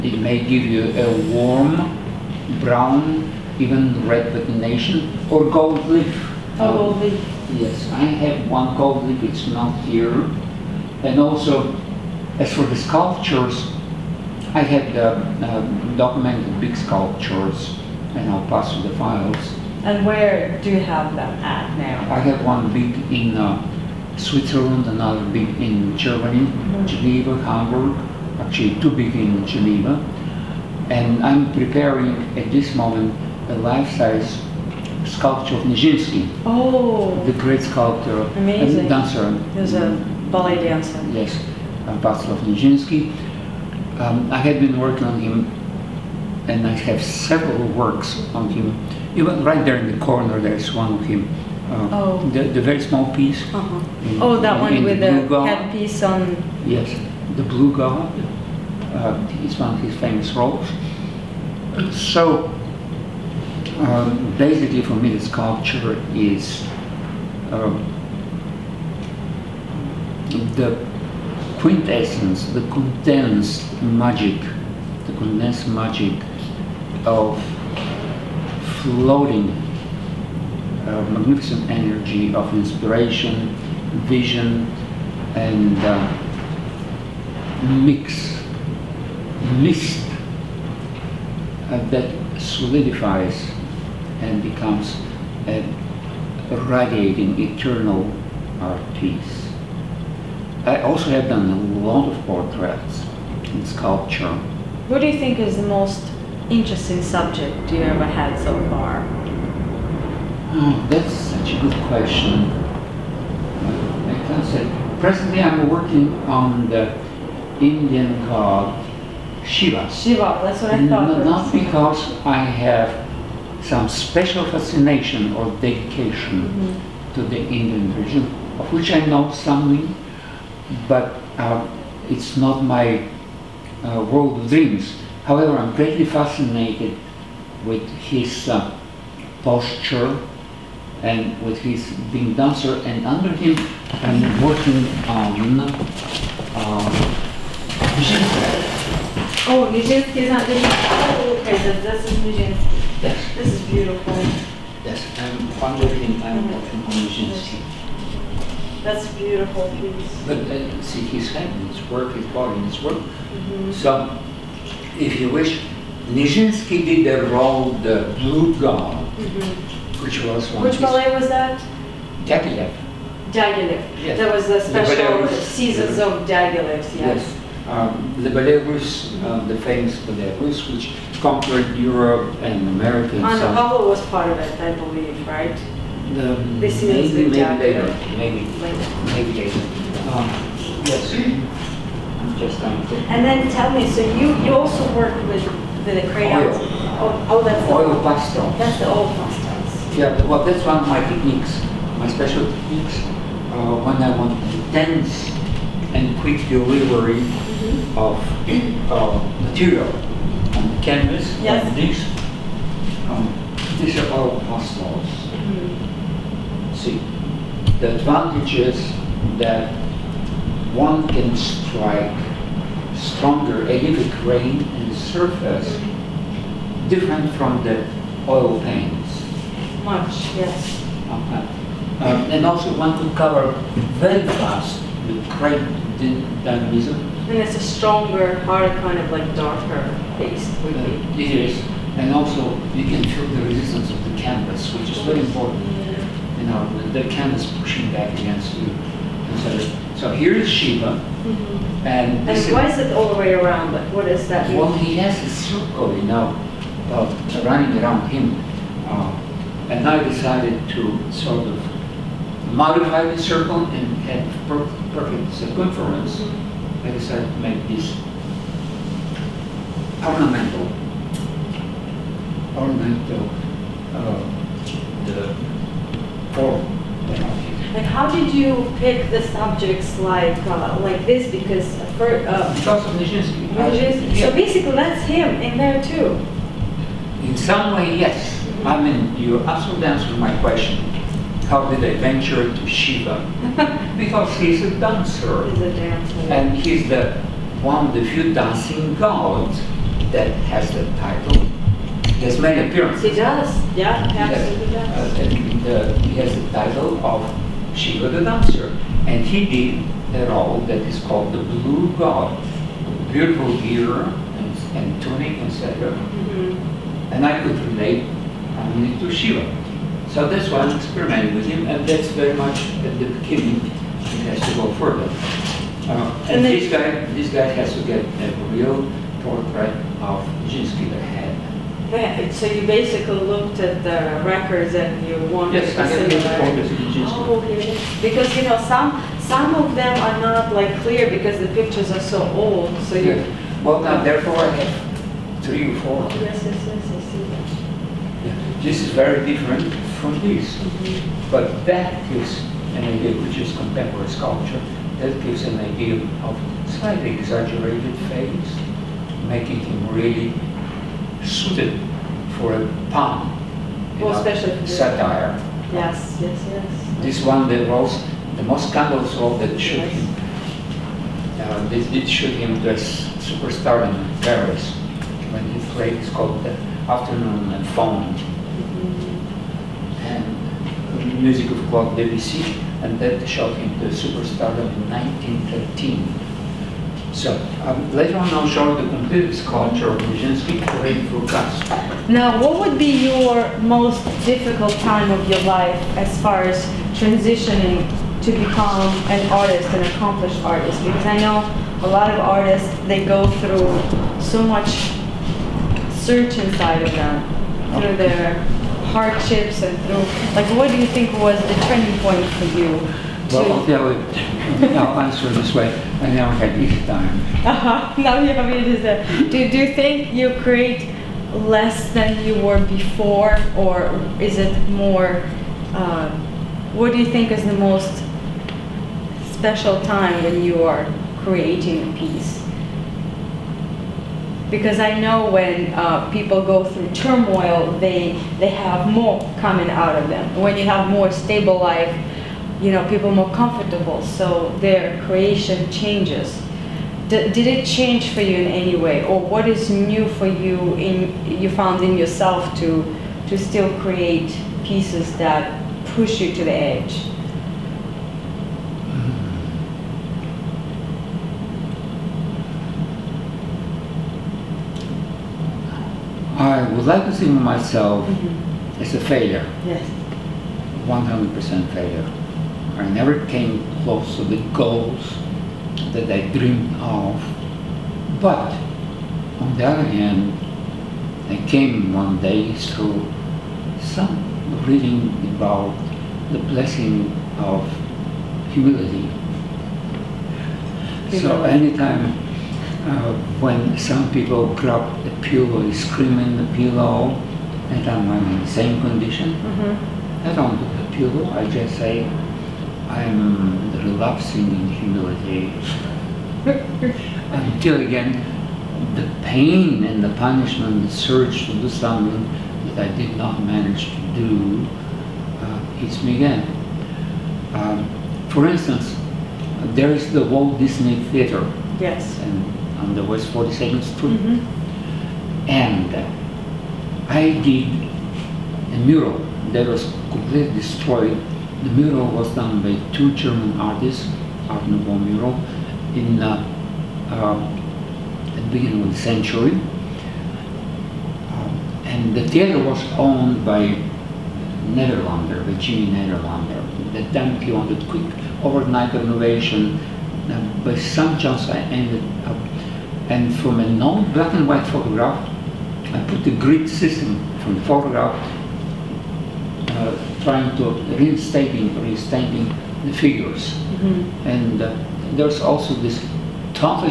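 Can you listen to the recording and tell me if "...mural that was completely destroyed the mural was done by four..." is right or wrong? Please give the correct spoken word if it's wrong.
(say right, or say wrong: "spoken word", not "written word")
wrong: "two", not "four".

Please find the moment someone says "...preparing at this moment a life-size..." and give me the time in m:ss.
0:31.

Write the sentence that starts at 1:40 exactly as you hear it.
I also have done a lot of portraits and sculpture.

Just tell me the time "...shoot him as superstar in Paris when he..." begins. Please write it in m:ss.
6:12.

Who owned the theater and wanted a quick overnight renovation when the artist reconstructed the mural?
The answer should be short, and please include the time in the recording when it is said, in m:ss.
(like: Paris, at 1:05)
Jimmy Nederlander, at 9:05.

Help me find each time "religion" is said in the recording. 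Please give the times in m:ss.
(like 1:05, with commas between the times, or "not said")
2:07.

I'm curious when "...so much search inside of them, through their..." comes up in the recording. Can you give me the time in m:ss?
6:44.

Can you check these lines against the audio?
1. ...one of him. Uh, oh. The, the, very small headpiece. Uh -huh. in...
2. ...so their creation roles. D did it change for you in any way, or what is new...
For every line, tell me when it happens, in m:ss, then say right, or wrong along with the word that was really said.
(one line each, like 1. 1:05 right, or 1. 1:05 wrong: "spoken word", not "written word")
1. 0:50 wrong: "piece", not "headpiece"
2. 7:24 wrong: "changes", not "roles".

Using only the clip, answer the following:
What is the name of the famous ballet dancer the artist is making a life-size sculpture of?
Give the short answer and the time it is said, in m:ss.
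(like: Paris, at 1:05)
Václav Nijinsky, at 0:41.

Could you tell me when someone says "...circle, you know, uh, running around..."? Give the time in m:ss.
4:15.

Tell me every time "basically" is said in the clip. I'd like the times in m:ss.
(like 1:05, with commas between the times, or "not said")
1:04, 4:44, 5:32.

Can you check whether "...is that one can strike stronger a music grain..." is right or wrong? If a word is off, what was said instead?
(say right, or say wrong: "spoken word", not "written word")
wrong: "acidic", not "music".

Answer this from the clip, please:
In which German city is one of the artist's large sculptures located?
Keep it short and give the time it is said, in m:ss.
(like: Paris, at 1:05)
Hamburg, at 0:27.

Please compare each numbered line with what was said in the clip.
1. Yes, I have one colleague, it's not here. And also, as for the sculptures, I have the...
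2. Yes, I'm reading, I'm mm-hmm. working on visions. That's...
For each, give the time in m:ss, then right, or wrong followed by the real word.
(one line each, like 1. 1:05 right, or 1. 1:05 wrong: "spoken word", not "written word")
1. 0:07 right
2. 2:34 wrong: "fondling", not "reading".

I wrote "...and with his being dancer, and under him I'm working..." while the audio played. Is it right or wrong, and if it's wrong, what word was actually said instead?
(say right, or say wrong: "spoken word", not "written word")
right.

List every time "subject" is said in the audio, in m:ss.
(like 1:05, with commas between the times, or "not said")
1:47, 4:39.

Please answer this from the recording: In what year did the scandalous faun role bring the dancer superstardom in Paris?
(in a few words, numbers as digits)
1913.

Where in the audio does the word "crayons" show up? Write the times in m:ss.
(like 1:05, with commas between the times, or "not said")
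3:16.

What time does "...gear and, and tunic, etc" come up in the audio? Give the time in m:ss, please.
5:13.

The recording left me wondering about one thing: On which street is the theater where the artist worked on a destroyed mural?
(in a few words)
West 42nd Street.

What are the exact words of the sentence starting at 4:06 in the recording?
You know, the, the canvas pushing back against you.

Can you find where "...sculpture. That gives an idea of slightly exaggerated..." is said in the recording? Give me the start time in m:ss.
5:54.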